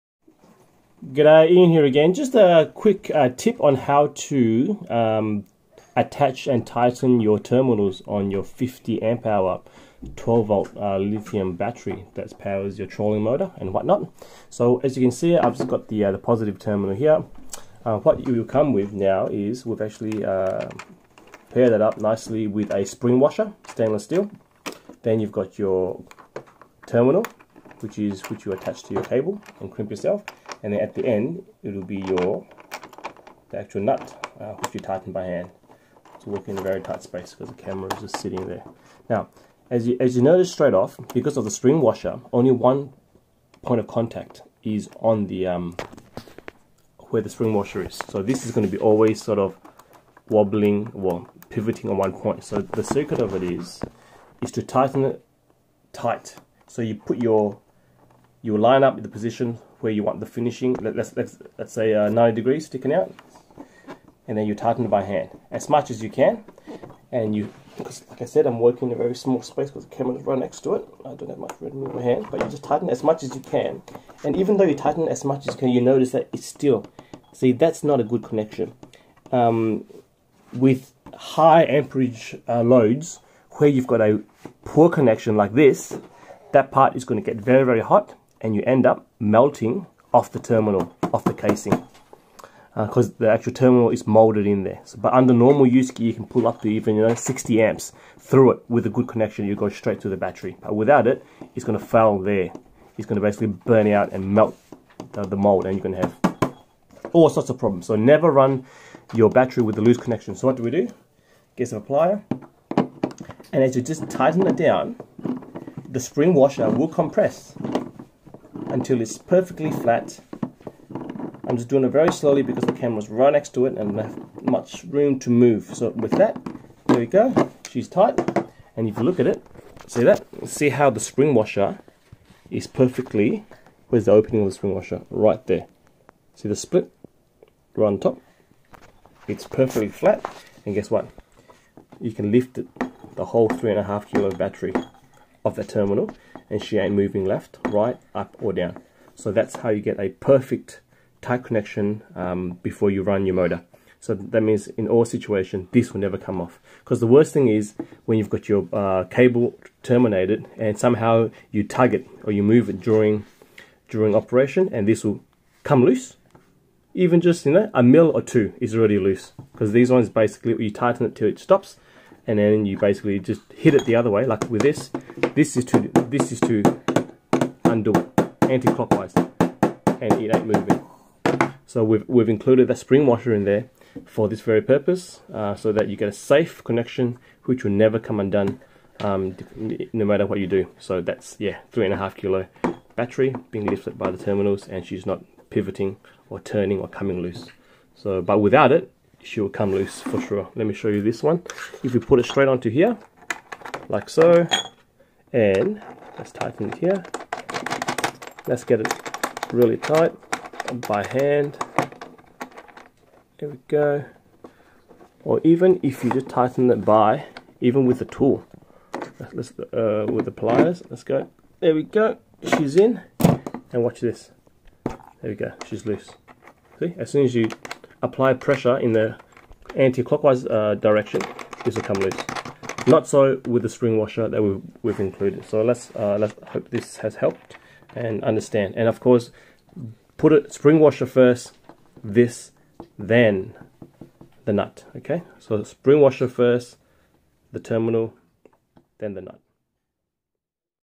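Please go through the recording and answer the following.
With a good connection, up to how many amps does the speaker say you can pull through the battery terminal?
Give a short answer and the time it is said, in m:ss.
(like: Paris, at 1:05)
60 amps, at 1:37.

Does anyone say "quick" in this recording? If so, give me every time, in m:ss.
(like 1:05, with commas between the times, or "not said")
0:02.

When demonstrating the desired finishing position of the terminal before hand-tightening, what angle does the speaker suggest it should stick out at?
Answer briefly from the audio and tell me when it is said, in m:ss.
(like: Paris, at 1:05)
90 degrees, at 1:02.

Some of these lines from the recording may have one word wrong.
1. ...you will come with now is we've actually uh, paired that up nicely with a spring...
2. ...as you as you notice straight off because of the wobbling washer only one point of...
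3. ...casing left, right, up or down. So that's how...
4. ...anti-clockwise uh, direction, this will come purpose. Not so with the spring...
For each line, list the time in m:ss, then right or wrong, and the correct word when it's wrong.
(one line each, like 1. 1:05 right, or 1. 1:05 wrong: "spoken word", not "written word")
1. 0:18 right
2. 0:39 wrong: "spring", not "wobbling"
3. 2:26 wrong: "moving", not "casing"
4. 3:49 wrong: "loose", not "purpose".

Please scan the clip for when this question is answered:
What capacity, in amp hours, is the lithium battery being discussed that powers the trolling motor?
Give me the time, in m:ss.
0:08.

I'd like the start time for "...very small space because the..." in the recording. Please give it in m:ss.
1:08.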